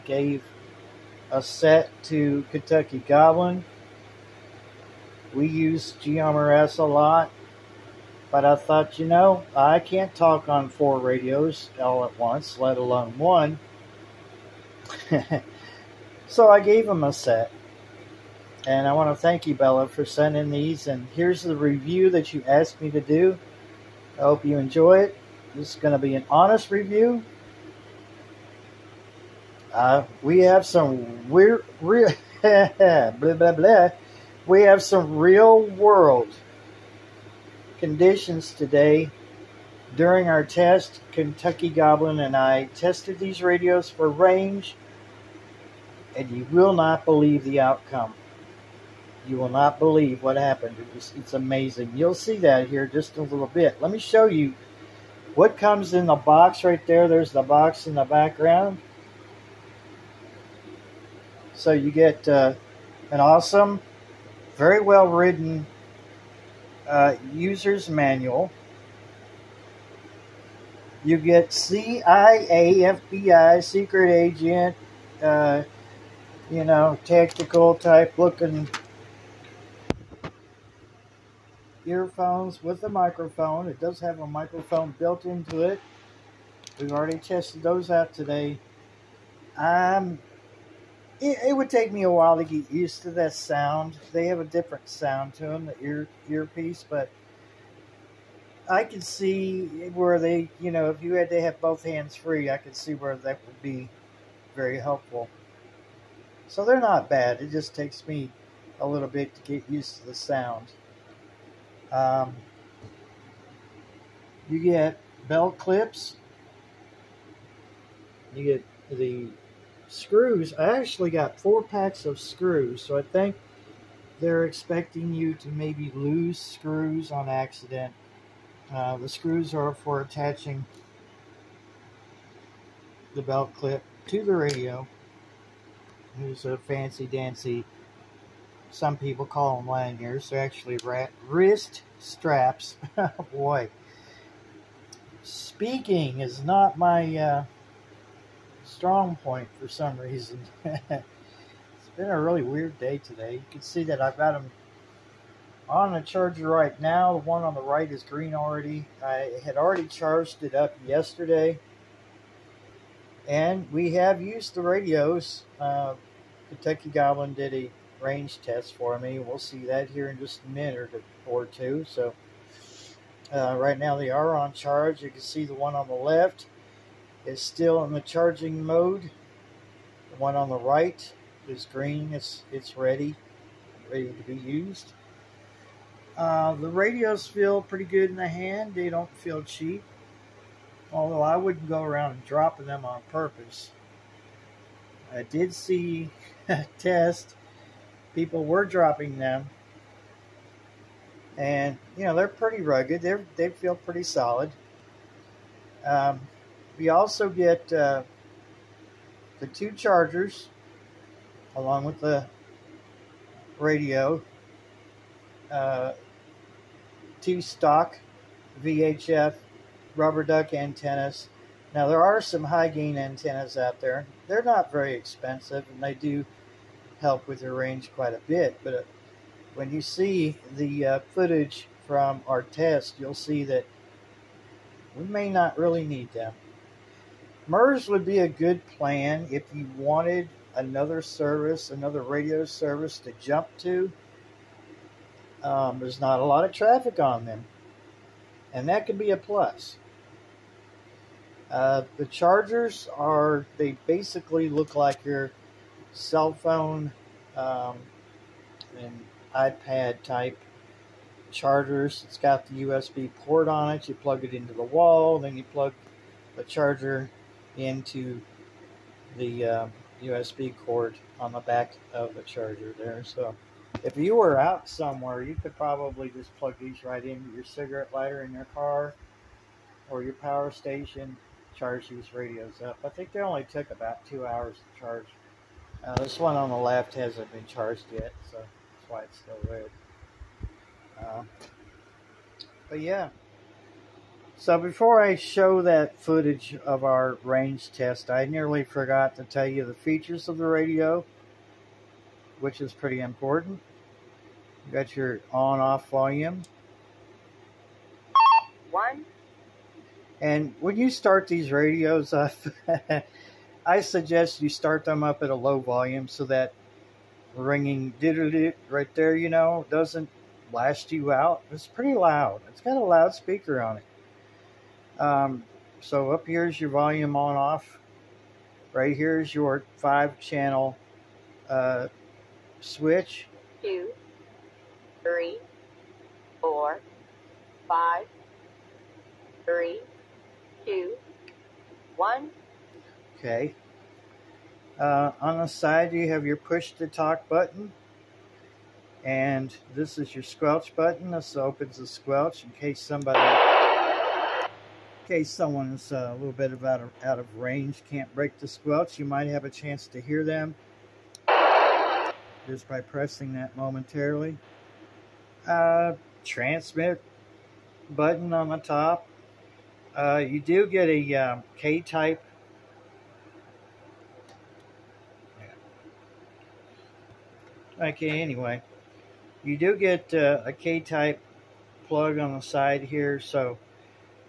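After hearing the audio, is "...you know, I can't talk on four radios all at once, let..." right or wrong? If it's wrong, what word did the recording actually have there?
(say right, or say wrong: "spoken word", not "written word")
right.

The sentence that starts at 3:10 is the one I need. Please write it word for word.
Although I wouldn't go around dropping them on purpose.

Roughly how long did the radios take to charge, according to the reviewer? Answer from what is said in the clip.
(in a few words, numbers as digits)
2 hours.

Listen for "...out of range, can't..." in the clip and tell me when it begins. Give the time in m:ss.
5:57.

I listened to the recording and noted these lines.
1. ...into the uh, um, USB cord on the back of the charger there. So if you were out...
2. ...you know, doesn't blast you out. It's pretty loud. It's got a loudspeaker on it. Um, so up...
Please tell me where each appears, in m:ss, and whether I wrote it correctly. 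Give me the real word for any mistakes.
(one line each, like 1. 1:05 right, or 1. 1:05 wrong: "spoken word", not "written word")
1. 4:27 right
2. 5:19 right.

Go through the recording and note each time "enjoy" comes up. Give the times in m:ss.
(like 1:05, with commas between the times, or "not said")
0:24.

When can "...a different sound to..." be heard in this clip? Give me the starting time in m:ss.
1:34.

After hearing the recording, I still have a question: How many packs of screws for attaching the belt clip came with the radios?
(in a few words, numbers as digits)
4.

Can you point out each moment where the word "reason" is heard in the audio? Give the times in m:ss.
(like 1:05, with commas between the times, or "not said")
2:29.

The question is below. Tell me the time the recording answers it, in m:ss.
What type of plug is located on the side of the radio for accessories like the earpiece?
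6:20.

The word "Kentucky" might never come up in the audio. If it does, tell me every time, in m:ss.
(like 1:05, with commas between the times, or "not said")
0:02, 0:41, 2:46.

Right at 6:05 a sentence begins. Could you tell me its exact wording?
Uh, transmit button on the top.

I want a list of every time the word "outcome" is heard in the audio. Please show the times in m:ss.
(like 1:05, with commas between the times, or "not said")
0:47.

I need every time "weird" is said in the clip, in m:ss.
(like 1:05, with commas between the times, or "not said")
0:31, 2:32.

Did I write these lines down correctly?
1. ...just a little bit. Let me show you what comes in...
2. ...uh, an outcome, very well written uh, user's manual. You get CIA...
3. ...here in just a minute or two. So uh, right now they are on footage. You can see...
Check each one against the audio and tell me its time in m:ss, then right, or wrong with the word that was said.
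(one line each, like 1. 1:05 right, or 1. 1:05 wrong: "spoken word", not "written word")
1. 0:52 right
2. 1:02 wrong: "awesome", not "outcome"
3. 2:49 wrong: "charge", not "footage".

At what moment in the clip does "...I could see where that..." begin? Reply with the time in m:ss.
1:42.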